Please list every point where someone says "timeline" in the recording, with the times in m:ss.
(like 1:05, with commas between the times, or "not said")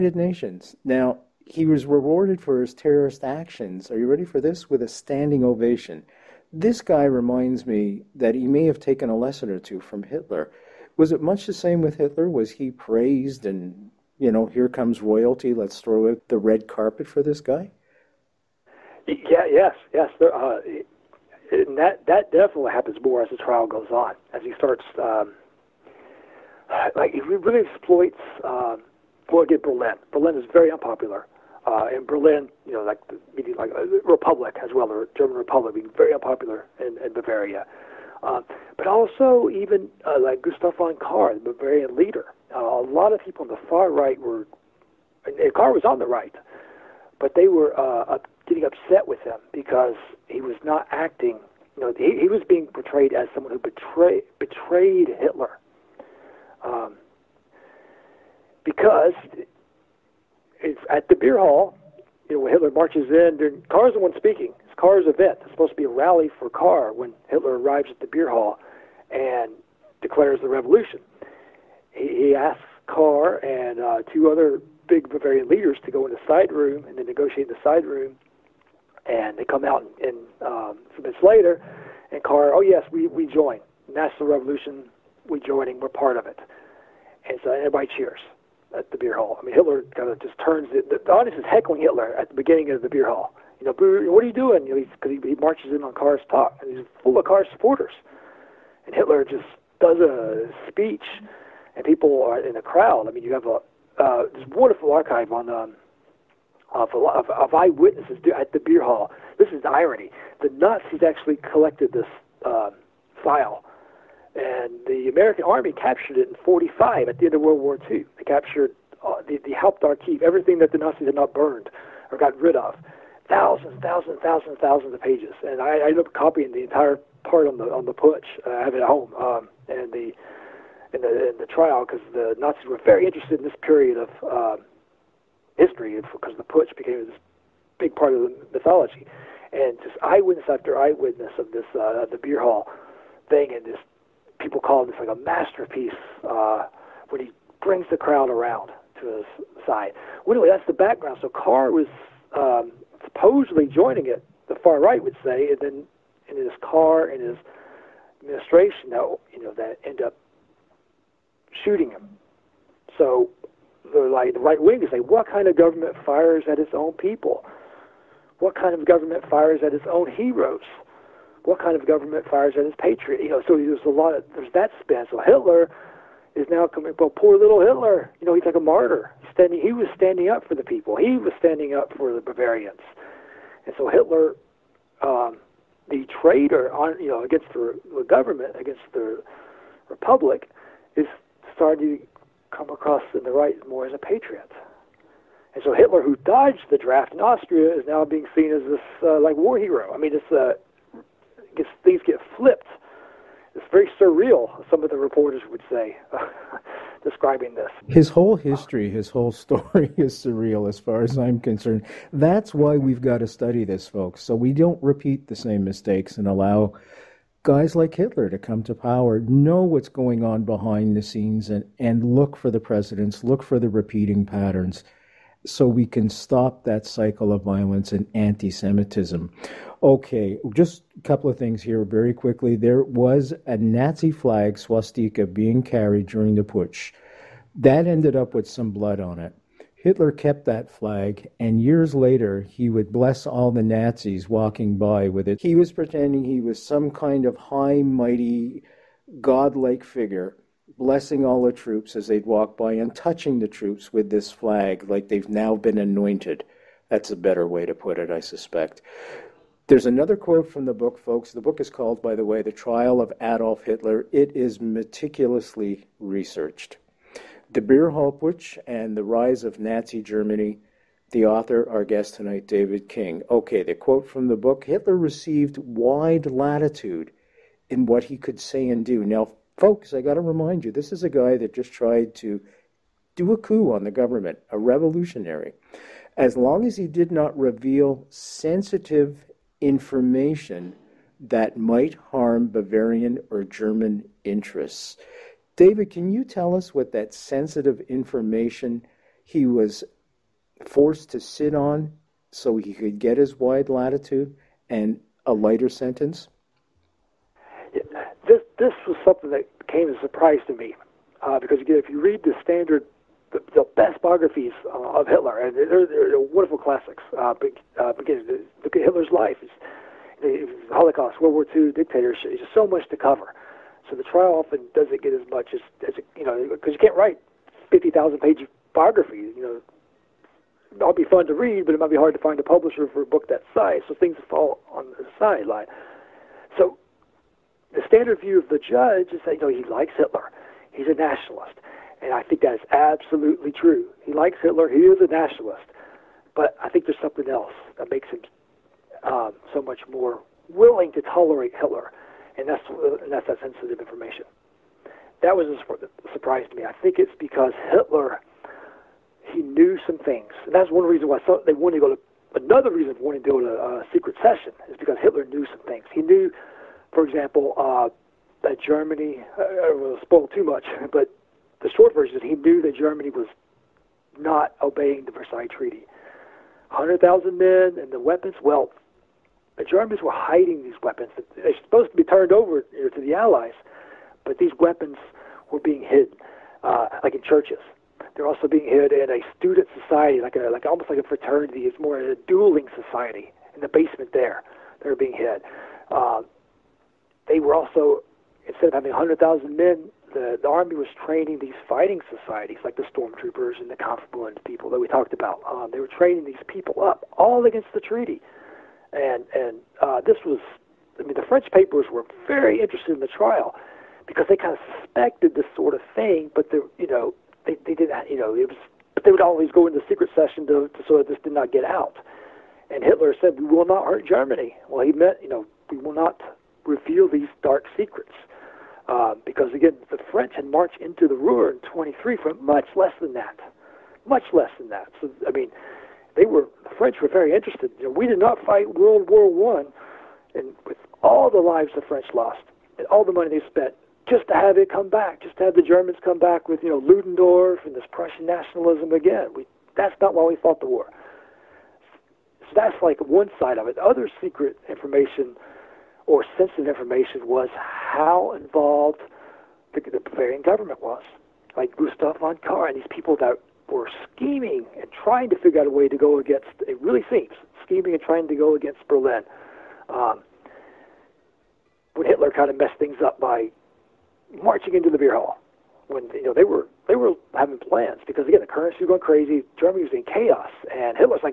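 not said.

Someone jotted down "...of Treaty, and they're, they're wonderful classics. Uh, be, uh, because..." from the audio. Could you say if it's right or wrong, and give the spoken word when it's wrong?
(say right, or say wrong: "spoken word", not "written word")
wrong: "Hitler", not "Treaty".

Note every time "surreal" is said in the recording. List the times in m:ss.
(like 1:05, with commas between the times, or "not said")
3:24, 3:30.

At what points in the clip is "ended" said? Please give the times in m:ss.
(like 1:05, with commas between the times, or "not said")
2:05, 3:57.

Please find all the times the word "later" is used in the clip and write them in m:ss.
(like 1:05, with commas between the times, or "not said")
1:21, 4:01.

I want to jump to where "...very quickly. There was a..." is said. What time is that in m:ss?
3:51.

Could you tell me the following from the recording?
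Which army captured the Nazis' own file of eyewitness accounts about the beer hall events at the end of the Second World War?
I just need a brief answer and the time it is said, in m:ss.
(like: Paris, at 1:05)
The American Army, at 1:55.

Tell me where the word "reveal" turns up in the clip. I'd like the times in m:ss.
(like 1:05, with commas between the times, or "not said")
4:47, 7:06.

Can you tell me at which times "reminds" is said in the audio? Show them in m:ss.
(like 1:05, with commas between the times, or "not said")
0:07, 4:40.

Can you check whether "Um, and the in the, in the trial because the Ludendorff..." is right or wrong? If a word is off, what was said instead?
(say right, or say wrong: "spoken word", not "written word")
wrong: "Nazis", not "Ludendorff".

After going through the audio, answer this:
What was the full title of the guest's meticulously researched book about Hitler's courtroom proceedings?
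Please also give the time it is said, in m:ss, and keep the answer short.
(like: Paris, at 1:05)
The Trial of Adolf Hitler, at 4:22.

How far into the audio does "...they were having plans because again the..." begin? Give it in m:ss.
7:56.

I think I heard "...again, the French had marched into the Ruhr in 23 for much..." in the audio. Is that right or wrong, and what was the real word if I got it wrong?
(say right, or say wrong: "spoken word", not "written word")
right.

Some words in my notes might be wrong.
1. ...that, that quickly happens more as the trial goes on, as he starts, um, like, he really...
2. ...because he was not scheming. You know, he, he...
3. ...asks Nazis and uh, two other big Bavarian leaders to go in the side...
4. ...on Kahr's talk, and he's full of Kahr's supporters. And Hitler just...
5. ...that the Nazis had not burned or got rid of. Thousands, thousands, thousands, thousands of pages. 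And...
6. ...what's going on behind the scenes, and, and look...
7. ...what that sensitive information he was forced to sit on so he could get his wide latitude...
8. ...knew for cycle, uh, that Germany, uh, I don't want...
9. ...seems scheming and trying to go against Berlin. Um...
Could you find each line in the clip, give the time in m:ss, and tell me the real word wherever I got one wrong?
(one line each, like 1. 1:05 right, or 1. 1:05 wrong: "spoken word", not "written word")
1. 0:21 wrong: "definitely", not "quickly"
2. 0:49 wrong: "acting", not "scheming"
3. 1:12 wrong: "Kahr", not "Nazis"
4. 1:35 right
5. 2:00 right
6. 3:39 right
7. 4:56 right
8. 6:06 wrong: "example", not "cycle"
9. 7:47 right.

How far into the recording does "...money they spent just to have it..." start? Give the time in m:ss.
7:23.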